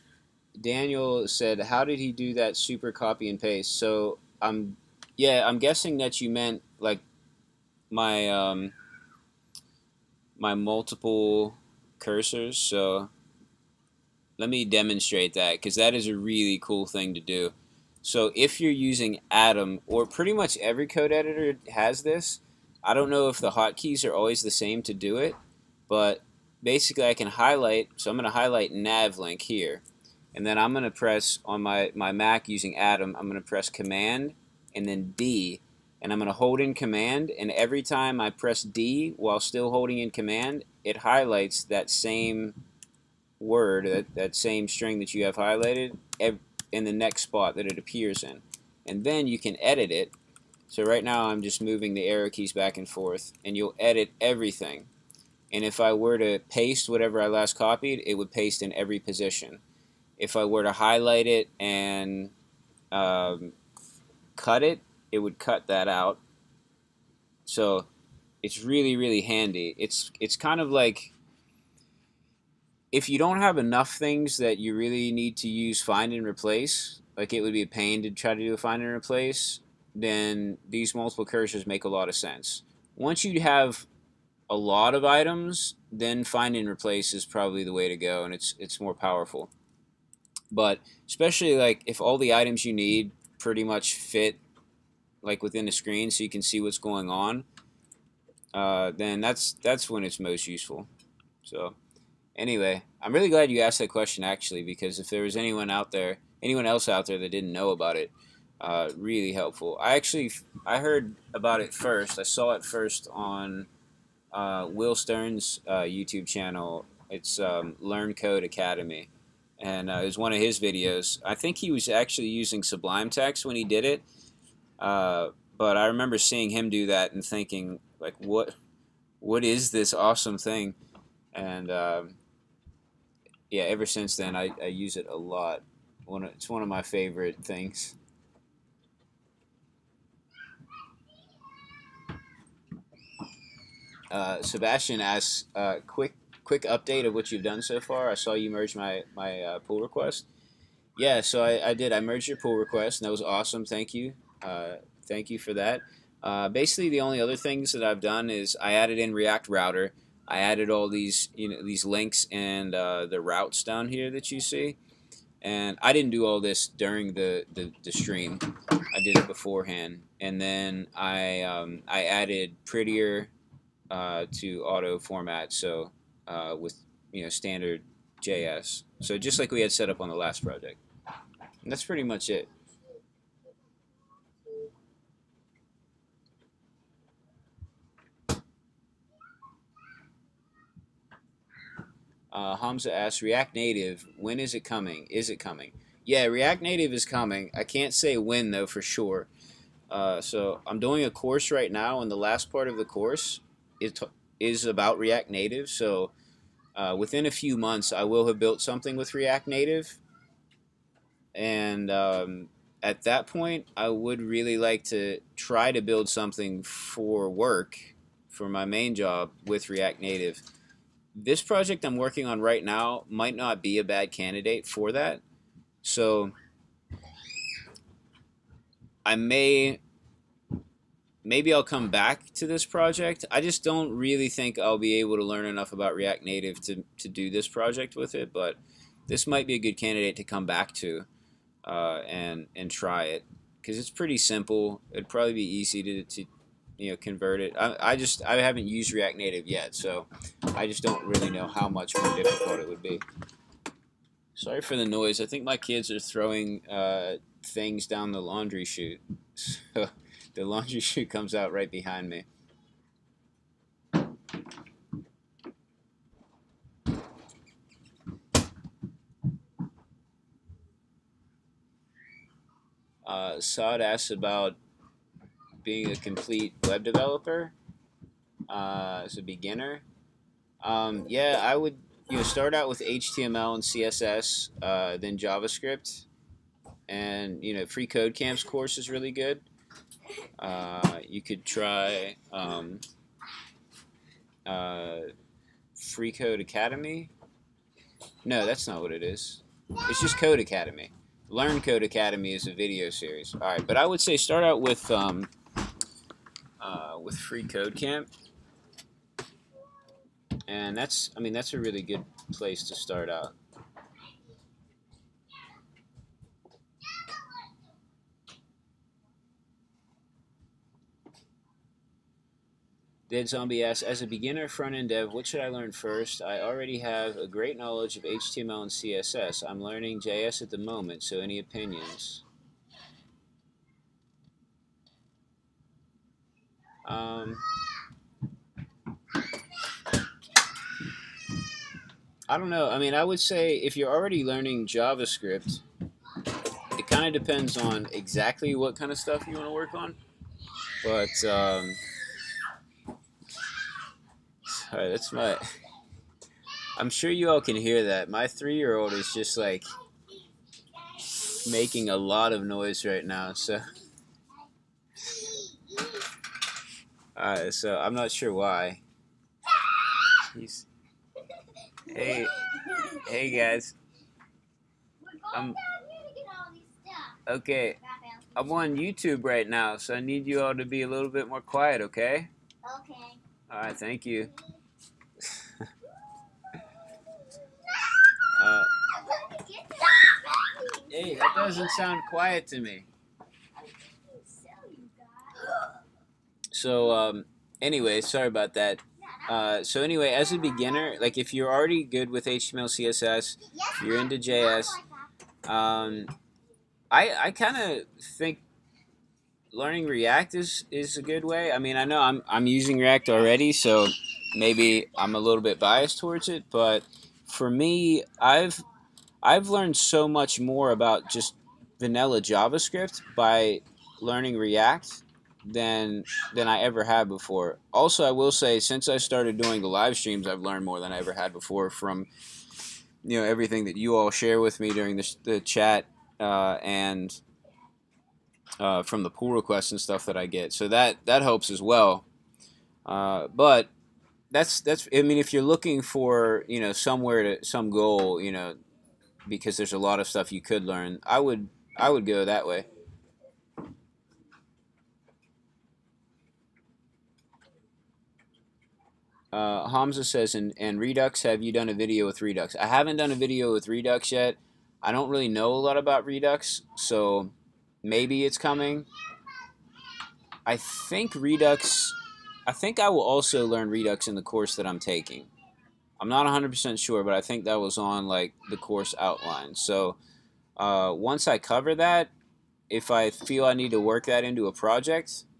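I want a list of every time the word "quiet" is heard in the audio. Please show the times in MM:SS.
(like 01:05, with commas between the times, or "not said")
06:21, 06:32.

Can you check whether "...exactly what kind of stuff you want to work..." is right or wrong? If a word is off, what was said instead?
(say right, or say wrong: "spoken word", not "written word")
right.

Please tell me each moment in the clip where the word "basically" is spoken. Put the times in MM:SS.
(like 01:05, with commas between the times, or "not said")
00:26, 02:36.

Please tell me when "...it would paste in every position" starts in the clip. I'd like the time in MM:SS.
00:58.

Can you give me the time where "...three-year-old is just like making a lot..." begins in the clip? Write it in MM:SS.
05:58.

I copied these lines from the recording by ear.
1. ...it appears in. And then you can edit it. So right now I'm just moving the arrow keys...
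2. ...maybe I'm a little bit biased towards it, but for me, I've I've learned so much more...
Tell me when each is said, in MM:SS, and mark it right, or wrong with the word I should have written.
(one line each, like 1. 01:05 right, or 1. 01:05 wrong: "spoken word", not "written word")
1. 00:47 right
2. 06:54 right.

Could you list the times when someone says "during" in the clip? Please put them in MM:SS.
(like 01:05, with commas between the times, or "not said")
02:46, 07:14.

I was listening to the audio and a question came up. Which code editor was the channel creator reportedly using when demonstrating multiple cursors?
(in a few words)
Sublime Text.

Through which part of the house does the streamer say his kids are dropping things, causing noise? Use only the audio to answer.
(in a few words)
laundry chute.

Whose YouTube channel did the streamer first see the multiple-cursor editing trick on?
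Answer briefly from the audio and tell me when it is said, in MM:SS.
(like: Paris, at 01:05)
Will Stern, at 01:54.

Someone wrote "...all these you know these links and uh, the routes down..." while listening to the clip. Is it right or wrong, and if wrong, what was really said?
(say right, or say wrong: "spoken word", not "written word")
right.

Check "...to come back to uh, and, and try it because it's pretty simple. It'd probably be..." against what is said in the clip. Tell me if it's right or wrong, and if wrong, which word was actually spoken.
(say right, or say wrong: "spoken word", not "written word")
right.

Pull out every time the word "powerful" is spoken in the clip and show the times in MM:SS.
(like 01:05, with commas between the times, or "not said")
01:28.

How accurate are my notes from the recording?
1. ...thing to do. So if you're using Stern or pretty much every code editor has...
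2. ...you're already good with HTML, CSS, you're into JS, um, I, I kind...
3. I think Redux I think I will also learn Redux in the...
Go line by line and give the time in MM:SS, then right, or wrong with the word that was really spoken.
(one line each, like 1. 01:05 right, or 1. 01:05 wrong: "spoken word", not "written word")
1. 00:16 wrong: "Atom", not "Stern"
2. 06:41 right
3. 07:50 right.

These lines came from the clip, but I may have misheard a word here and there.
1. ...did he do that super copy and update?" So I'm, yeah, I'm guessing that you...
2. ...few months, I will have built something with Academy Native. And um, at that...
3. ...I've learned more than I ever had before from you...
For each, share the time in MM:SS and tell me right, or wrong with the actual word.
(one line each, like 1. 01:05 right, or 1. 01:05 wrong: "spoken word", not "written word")
1. 00:01 wrong: "paste", not "update"
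2. 03:27 wrong: "React", not "Academy"
3. 07:10 right.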